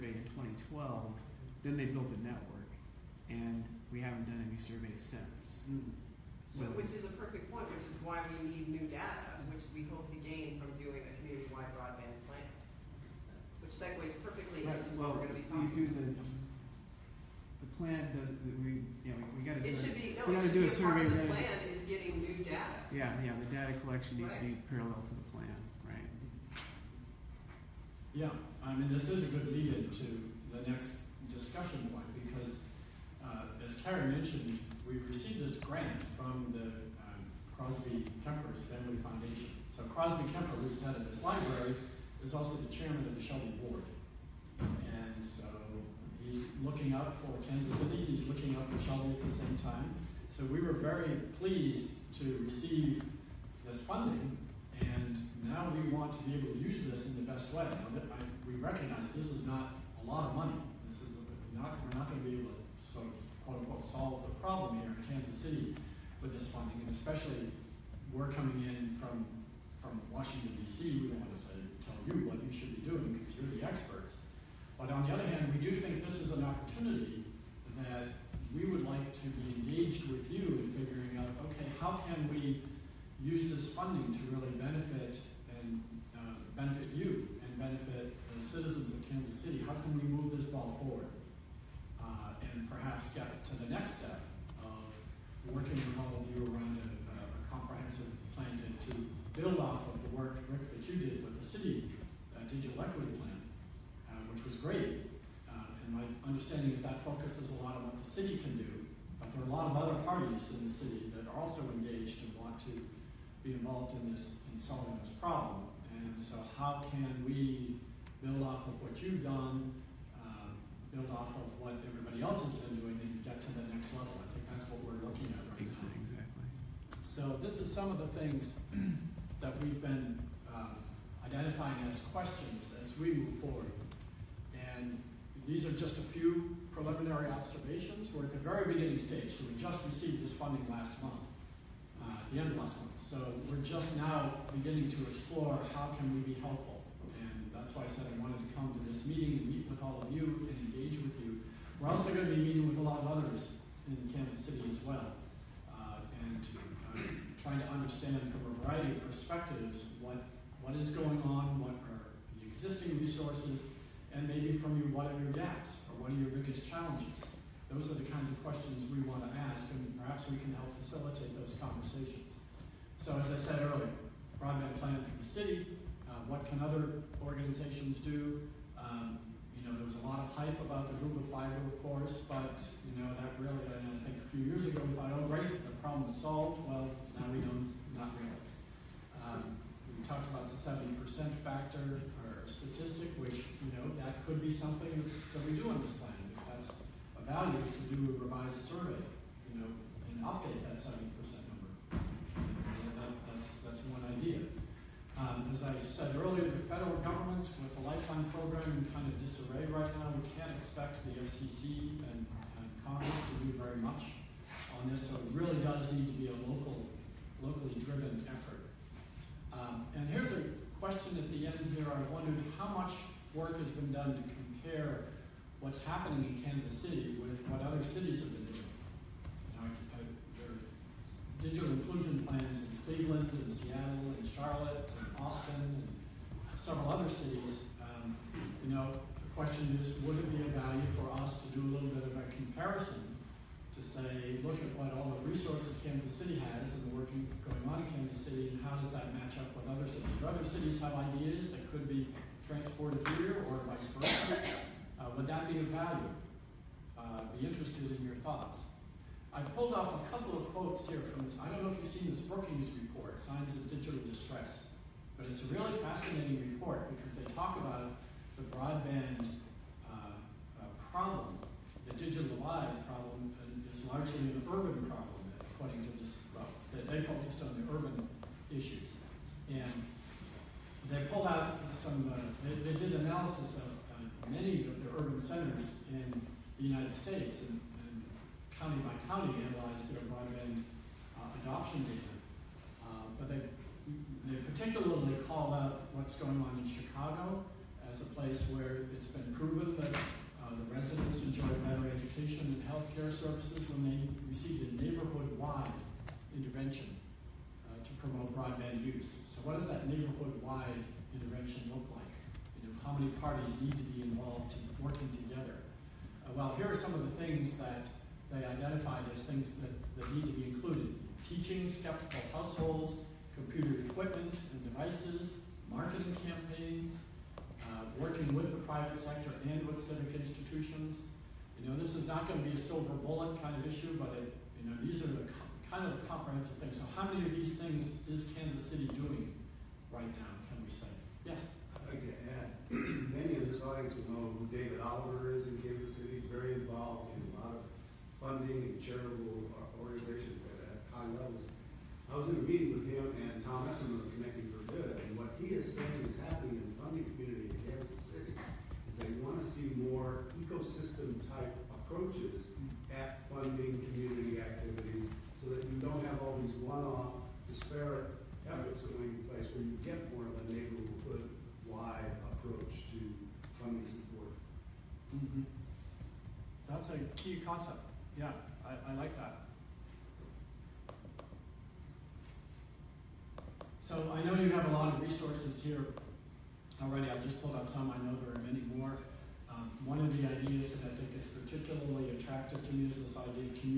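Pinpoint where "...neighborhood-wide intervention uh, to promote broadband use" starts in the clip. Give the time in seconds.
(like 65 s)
304 s.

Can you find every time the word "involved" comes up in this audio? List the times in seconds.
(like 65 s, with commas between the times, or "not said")
113 s, 314 s, 346 s.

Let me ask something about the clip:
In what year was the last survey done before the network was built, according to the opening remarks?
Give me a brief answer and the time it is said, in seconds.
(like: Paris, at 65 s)
2012, at 0 s.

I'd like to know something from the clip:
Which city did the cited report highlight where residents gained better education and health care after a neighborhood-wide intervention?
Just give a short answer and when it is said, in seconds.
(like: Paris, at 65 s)
Chicago, at 296 s.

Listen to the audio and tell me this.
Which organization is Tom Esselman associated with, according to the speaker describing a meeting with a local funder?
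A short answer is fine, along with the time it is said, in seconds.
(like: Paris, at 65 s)
Connecting for Good, at 354 s.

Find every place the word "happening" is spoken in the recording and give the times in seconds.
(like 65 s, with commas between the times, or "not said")
225 s, 356 s.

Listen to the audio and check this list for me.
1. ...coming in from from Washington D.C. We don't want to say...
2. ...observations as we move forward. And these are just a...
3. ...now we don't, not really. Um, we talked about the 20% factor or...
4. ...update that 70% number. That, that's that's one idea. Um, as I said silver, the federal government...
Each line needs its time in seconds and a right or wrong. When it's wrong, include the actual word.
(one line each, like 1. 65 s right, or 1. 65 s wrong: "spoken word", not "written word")
1. 68 s right
2. 132 s wrong: "questions", not "observations"
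3. 187 s wrong: "70", not "20"
4. 200 s wrong: "earlier", not "silver".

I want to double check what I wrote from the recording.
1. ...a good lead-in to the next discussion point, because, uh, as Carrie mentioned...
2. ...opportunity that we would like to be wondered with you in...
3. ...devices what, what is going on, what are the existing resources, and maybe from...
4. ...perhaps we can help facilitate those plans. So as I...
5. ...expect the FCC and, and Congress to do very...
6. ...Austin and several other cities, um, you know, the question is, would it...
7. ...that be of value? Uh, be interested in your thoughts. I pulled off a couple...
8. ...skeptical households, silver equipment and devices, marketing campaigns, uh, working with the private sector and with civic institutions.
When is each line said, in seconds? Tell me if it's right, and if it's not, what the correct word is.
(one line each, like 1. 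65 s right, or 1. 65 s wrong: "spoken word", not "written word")
1. 29 s right
2. 76 s wrong: "engaged", not "wondered"
3. 159 s wrong: "perspectives", not "devices"
4. 169 s wrong: "conversations", not "plans"
5. 210 s right
6. 235 s right
7. 255 s right
8. 321 s wrong: "computer", not "silver".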